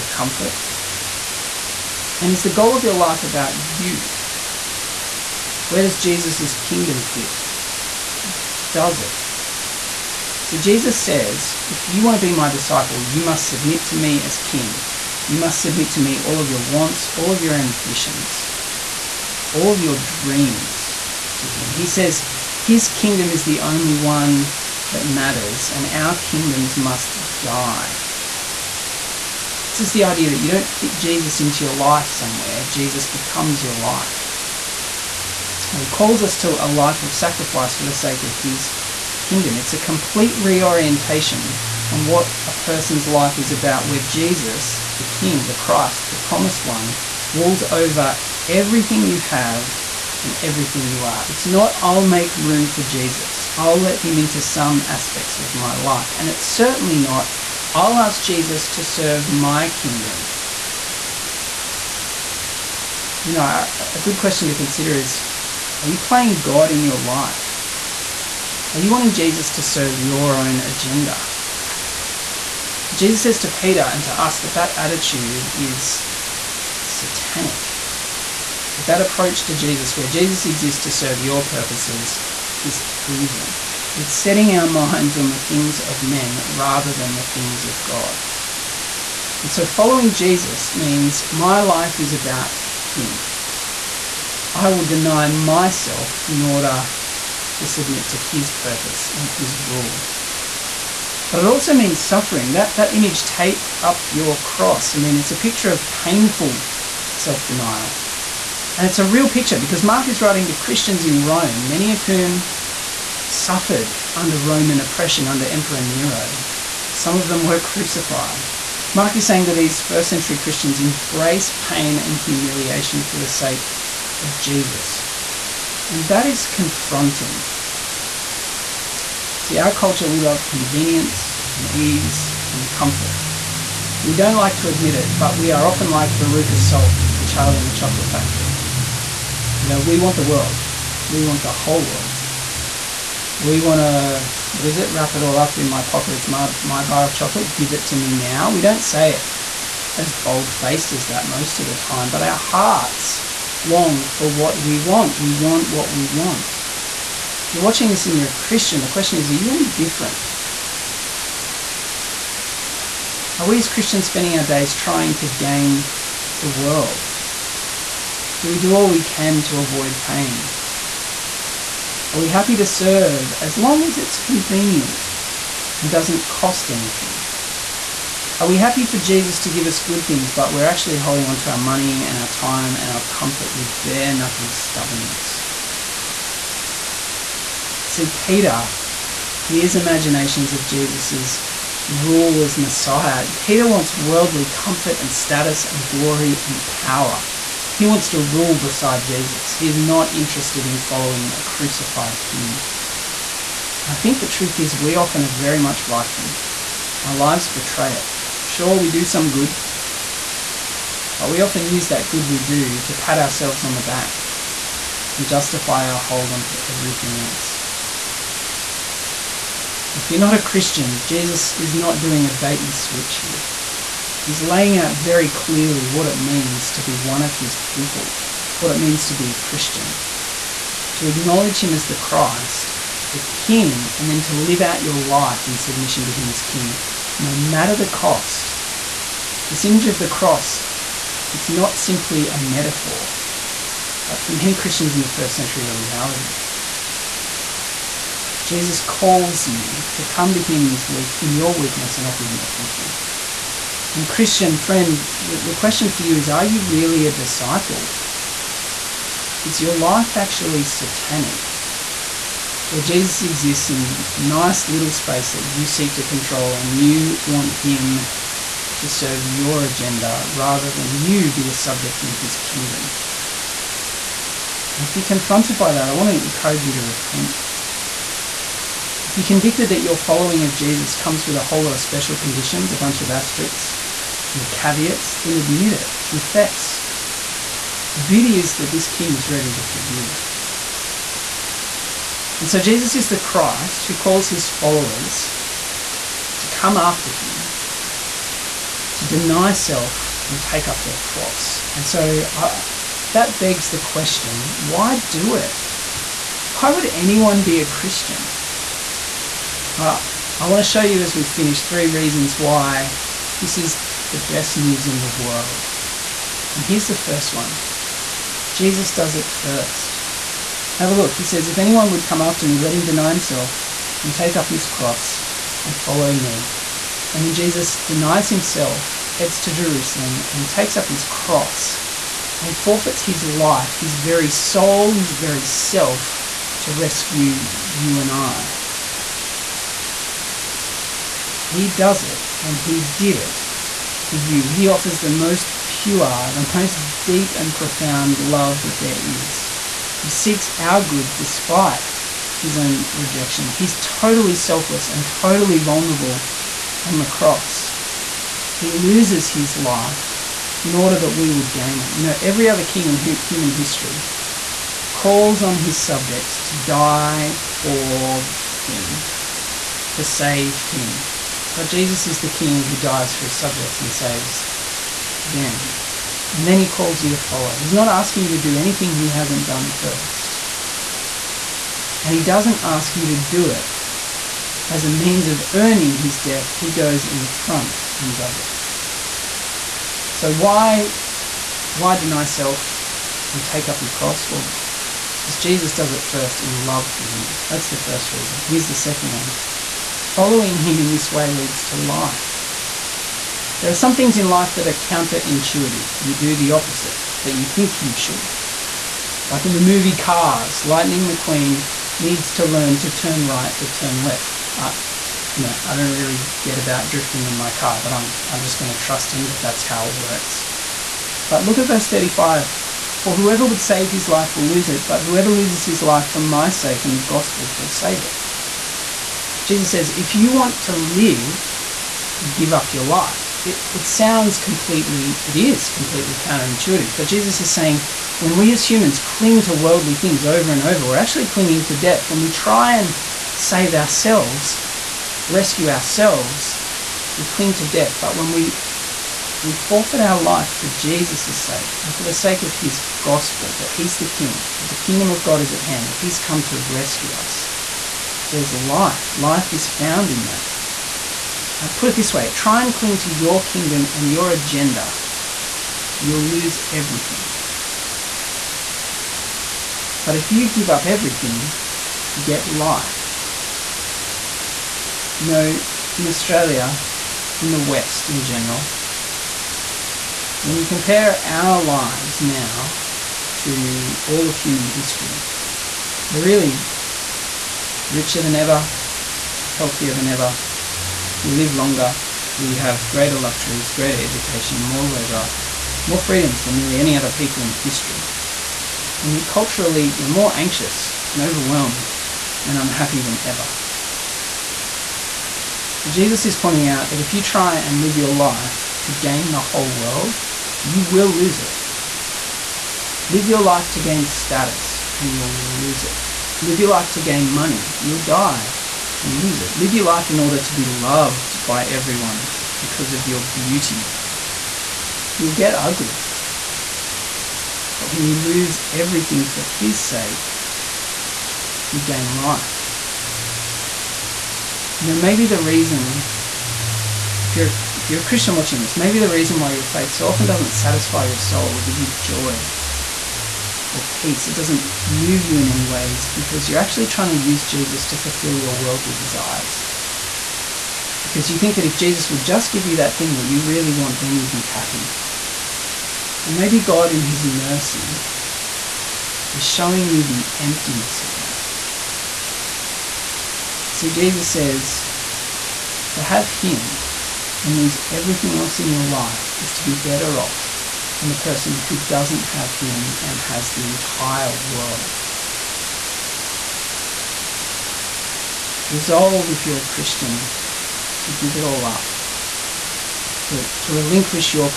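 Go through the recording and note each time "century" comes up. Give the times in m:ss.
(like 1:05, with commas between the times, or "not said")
2:00, 4:05.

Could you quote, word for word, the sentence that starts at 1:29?
And so following Jesus means my life is about Him.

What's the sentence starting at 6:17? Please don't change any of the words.
He's not asking you to do anything he hasn't done first.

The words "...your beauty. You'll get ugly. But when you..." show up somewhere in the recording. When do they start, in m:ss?
8:43.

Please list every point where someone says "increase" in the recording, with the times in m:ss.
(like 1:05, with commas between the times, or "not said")
not said.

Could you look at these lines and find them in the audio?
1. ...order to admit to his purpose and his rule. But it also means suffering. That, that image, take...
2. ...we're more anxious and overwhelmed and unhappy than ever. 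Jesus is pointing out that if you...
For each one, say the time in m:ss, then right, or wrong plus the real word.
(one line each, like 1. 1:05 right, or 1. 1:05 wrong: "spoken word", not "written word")
1. 1:36 wrong: "submit", not "admit"
2. 8:19 right.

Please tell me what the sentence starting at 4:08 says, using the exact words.
Jesus calls you to come to him in, his in your weakness and offer him everything.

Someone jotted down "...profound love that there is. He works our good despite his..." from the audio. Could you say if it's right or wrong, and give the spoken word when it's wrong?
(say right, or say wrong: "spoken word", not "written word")
wrong: "seeks", not "works".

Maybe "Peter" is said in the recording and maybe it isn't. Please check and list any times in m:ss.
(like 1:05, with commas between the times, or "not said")
1:13, 3:08, 3:13.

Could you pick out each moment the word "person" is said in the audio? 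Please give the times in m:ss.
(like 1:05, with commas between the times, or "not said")
0:42, 9:31.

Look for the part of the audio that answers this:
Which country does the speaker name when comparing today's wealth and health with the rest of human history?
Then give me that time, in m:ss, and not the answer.
7:56.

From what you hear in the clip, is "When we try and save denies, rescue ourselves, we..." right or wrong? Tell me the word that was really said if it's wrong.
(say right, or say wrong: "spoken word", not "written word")
wrong: "ourselves", not "denies".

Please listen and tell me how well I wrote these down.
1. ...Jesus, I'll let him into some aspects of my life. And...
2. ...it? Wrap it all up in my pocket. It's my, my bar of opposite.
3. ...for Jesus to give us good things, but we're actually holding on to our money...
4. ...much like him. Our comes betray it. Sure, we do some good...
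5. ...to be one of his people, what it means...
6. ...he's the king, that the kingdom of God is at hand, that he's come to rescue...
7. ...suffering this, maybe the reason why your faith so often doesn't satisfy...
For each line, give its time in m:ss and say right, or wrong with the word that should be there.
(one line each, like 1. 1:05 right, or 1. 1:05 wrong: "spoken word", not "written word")
1. 0:52 right
2. 2:24 wrong: "chocolate", not "opposite"
3. 2:58 right
4. 3:25 wrong: "lives", not "comes"
5. 3:46 right
6. 7:33 right
7. 8:58 wrong: "watching", not "suffering".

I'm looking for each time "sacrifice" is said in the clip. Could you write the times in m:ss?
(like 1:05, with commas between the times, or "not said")
0:37.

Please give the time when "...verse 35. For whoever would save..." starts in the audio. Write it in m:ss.
7:01.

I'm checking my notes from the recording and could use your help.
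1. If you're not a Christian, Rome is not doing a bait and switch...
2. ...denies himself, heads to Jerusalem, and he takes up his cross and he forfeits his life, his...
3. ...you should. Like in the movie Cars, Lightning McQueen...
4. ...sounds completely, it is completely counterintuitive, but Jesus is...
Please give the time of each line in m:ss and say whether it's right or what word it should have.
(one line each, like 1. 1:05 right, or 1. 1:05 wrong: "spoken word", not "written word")
1. 3:39 wrong: "Jesus", not "Rome"
2. 5:27 right
3. 6:47 right
4. 7:13 right.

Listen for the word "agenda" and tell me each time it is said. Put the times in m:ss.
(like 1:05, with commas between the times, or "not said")
1:10, 4:29, 7:44.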